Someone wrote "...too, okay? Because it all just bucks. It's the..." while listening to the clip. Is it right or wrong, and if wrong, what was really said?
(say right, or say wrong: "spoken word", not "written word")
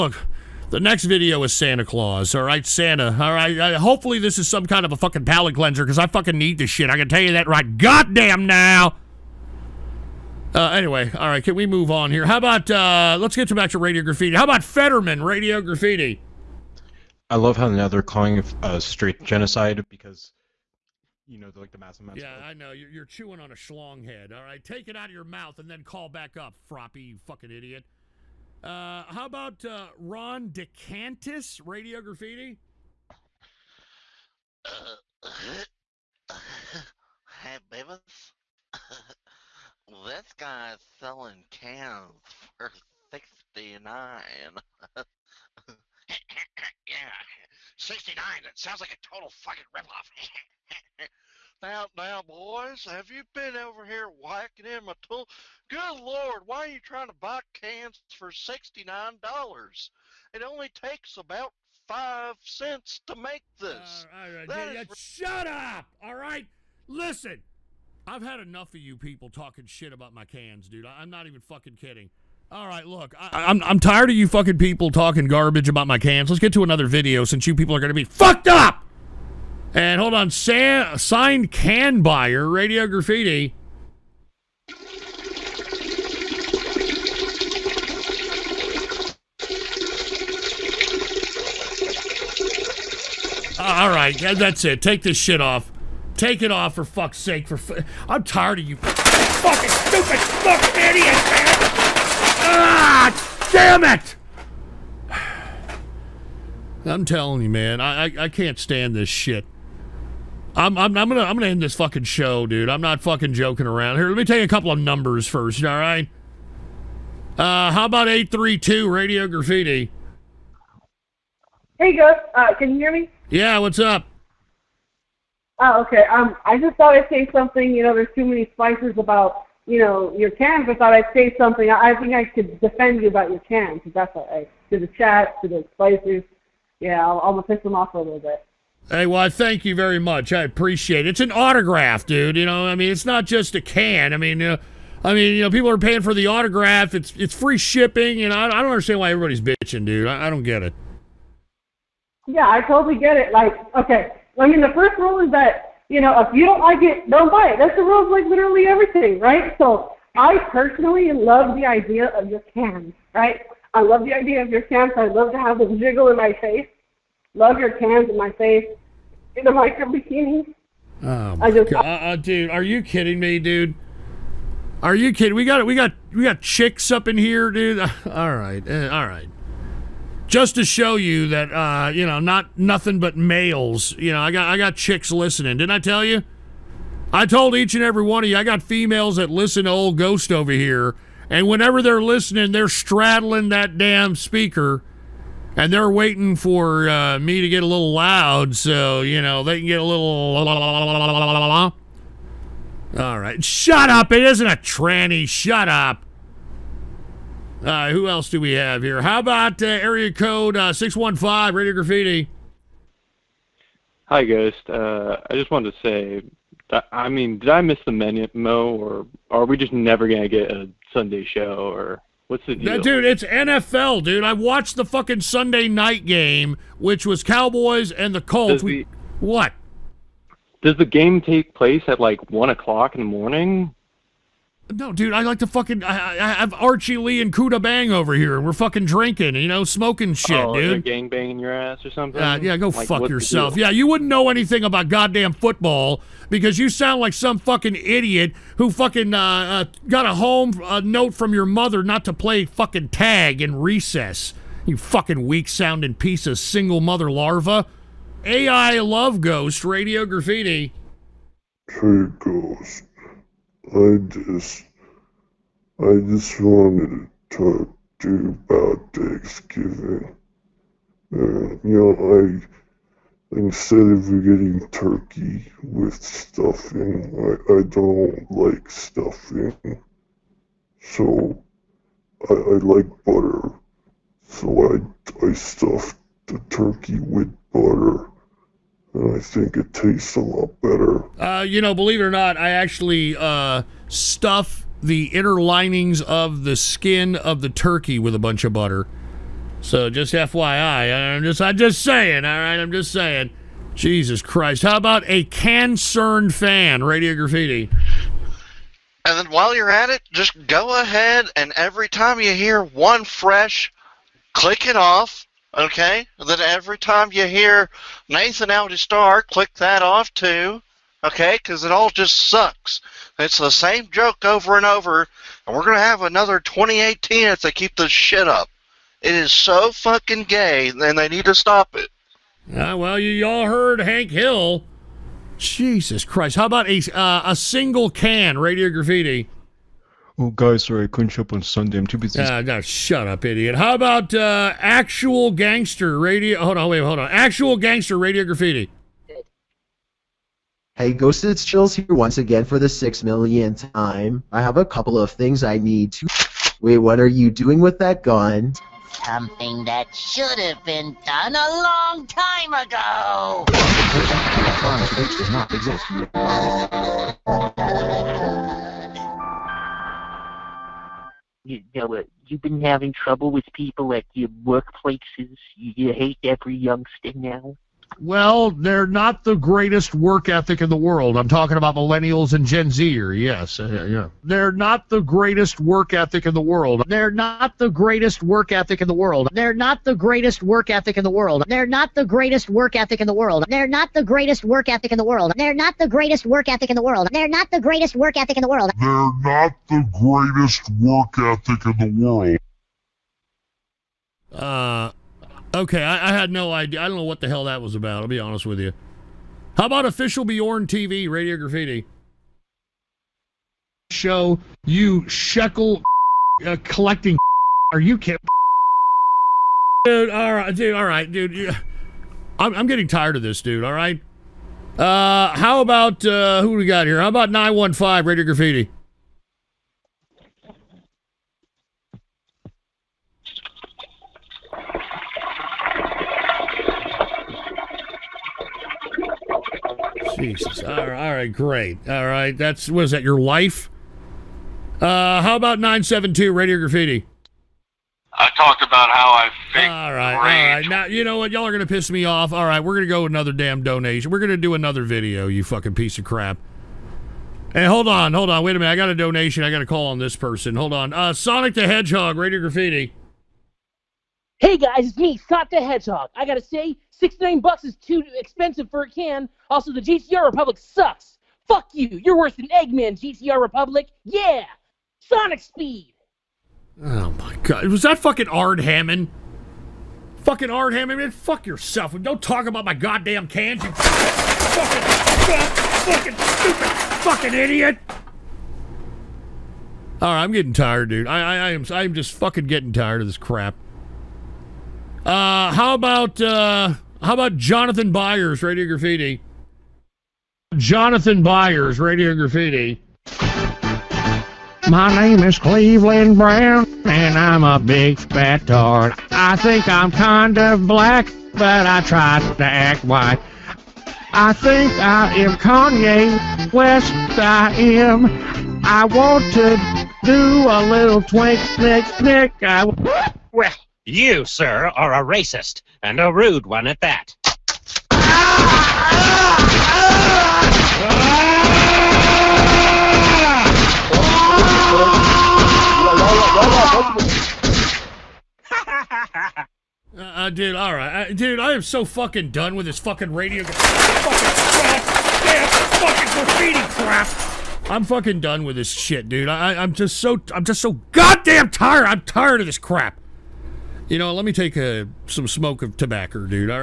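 wrong: "sucks", not "bucks".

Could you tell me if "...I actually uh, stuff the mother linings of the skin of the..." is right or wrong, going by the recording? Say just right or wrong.
wrong.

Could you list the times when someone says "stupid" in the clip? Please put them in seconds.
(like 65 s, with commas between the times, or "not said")
99 s, 486 s.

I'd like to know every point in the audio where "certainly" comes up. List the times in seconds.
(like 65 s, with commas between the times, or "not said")
not said.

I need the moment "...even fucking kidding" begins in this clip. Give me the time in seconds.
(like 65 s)
71 s.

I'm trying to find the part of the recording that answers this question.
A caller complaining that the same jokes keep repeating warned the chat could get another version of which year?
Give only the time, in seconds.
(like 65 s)
326 s.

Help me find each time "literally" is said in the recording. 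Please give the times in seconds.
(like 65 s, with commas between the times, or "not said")
158 s.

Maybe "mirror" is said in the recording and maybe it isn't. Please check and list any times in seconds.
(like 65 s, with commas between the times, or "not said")
not said.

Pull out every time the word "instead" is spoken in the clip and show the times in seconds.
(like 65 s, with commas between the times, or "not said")
273 s.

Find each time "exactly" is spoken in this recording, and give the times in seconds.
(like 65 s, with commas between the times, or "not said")
not said.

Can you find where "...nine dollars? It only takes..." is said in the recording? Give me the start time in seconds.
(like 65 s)
58 s.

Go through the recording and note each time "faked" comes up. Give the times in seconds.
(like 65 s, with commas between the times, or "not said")
449 s.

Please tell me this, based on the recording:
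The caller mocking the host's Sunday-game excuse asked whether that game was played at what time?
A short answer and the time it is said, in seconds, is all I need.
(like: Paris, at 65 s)
1 o'clock in the morning, at 232 s.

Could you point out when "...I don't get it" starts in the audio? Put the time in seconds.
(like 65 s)
150 s.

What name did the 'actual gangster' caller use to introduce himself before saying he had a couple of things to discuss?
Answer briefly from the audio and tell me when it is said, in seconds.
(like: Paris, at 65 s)
Chills, at 351 s.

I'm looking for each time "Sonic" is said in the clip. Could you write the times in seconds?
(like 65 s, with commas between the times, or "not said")
461 s, 465 s, 474 s.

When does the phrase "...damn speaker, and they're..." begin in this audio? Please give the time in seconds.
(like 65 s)
193 s.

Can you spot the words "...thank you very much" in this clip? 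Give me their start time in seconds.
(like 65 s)
139 s.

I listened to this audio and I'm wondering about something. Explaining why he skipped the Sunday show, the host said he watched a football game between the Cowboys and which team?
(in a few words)
Colts.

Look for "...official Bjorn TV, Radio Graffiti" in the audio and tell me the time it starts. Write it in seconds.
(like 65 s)
409 s.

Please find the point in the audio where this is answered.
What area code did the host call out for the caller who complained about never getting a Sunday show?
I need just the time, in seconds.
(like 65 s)
210 s.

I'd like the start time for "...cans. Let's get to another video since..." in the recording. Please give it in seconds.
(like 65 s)
75 s.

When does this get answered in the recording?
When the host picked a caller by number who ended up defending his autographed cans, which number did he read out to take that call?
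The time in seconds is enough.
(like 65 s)
118 s.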